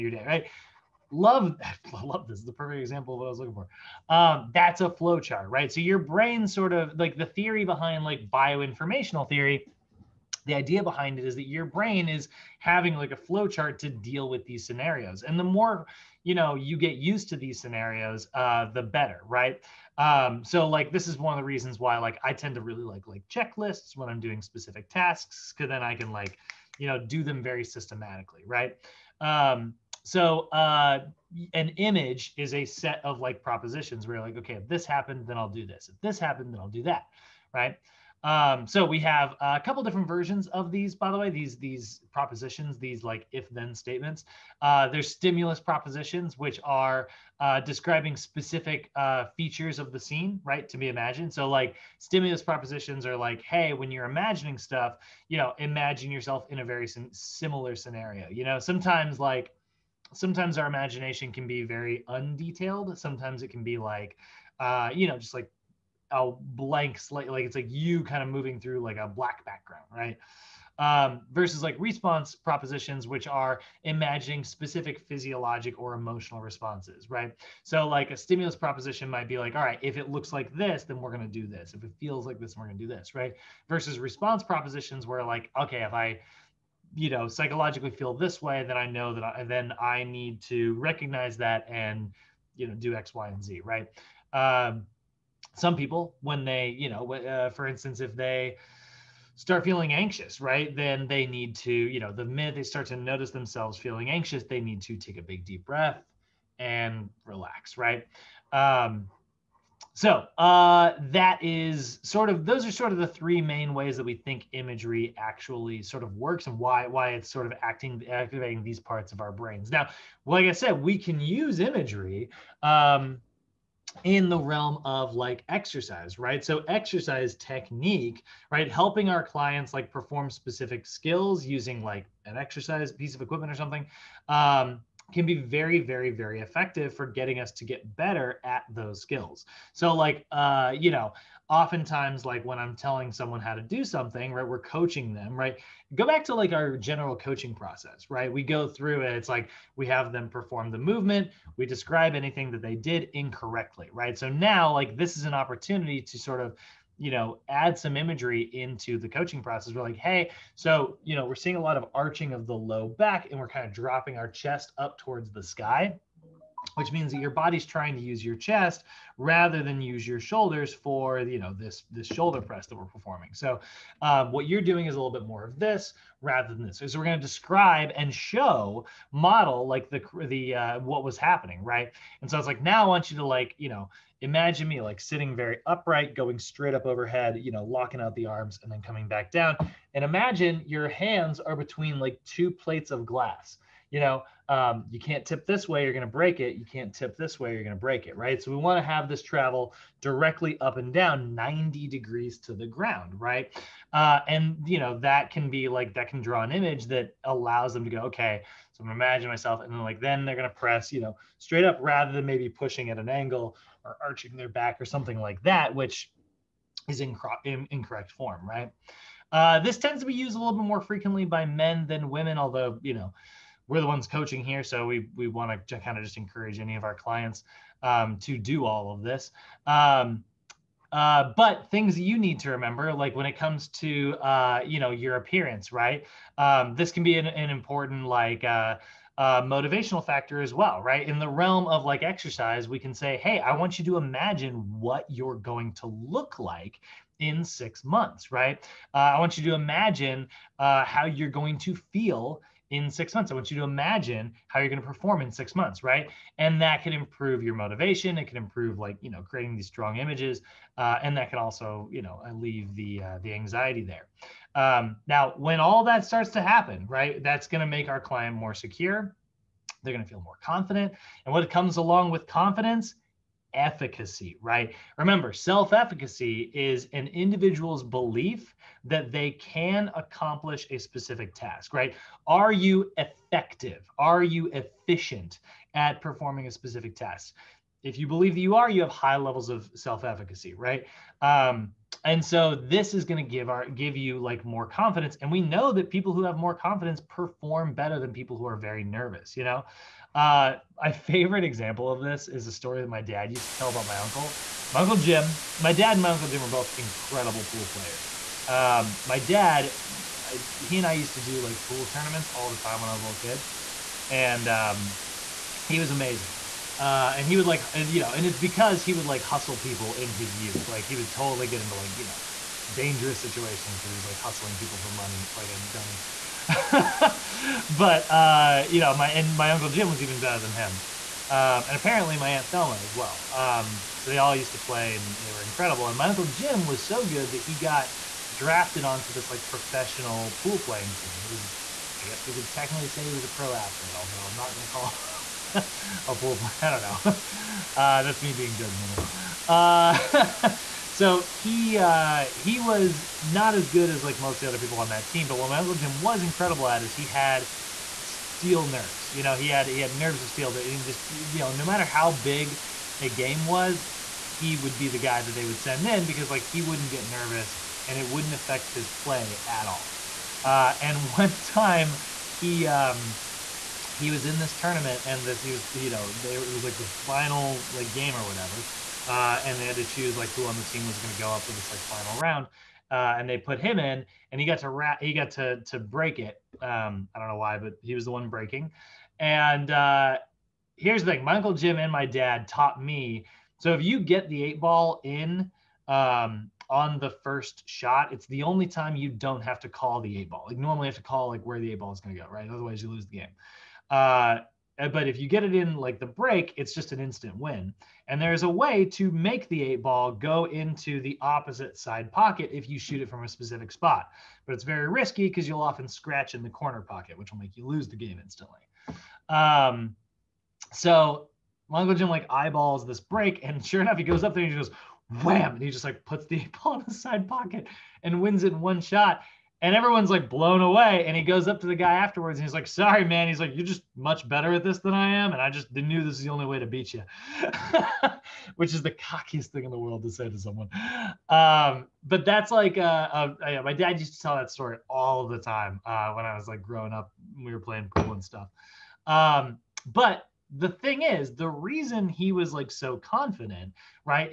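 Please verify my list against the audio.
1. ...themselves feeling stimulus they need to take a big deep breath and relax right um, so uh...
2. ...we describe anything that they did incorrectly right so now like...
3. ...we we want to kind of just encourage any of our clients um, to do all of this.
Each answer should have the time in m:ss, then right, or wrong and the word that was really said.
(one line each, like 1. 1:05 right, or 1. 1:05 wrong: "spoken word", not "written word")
1. 1:43 wrong: "anxious", not "stimulus"
2. 2:31 right
3. 3:44 right.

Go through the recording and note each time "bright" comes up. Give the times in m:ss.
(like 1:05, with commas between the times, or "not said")
not said.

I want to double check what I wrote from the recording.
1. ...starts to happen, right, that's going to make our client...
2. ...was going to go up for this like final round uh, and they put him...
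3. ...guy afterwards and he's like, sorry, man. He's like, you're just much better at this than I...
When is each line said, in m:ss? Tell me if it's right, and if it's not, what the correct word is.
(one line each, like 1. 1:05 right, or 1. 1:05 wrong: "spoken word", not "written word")
1. 4:26 right
2. 6:20 right
3. 7:11 right.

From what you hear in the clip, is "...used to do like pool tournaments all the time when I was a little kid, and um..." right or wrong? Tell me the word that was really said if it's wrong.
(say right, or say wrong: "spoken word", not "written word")
right.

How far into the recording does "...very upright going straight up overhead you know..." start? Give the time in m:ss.
3:05.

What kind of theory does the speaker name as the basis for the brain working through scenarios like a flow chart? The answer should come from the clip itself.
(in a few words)
bioinformational theory.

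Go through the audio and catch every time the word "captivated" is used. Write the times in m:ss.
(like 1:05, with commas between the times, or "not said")
not said.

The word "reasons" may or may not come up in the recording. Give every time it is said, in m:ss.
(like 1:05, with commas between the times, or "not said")
0:21, 7:31.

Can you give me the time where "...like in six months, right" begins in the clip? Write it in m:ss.
4:06.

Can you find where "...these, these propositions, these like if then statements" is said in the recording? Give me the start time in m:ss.
0:41.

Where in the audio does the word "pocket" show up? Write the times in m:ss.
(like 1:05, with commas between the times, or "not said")
6:52, 6:56, 7:07.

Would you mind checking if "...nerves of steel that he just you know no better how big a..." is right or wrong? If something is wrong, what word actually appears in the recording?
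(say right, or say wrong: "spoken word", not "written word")
wrong: "matter", not "better".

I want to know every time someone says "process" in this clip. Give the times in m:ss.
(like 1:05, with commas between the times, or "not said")
2:27, 2:39.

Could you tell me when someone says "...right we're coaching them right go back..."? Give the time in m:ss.
2:24.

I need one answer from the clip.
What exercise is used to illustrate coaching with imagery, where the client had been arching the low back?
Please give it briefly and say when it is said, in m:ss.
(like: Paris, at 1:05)
shoulder press, at 2:52.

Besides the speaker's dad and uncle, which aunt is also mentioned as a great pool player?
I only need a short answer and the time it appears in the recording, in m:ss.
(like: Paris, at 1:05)
Thelma, at 5:32.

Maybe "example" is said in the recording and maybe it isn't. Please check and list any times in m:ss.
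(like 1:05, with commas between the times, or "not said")
0:02, 5:01.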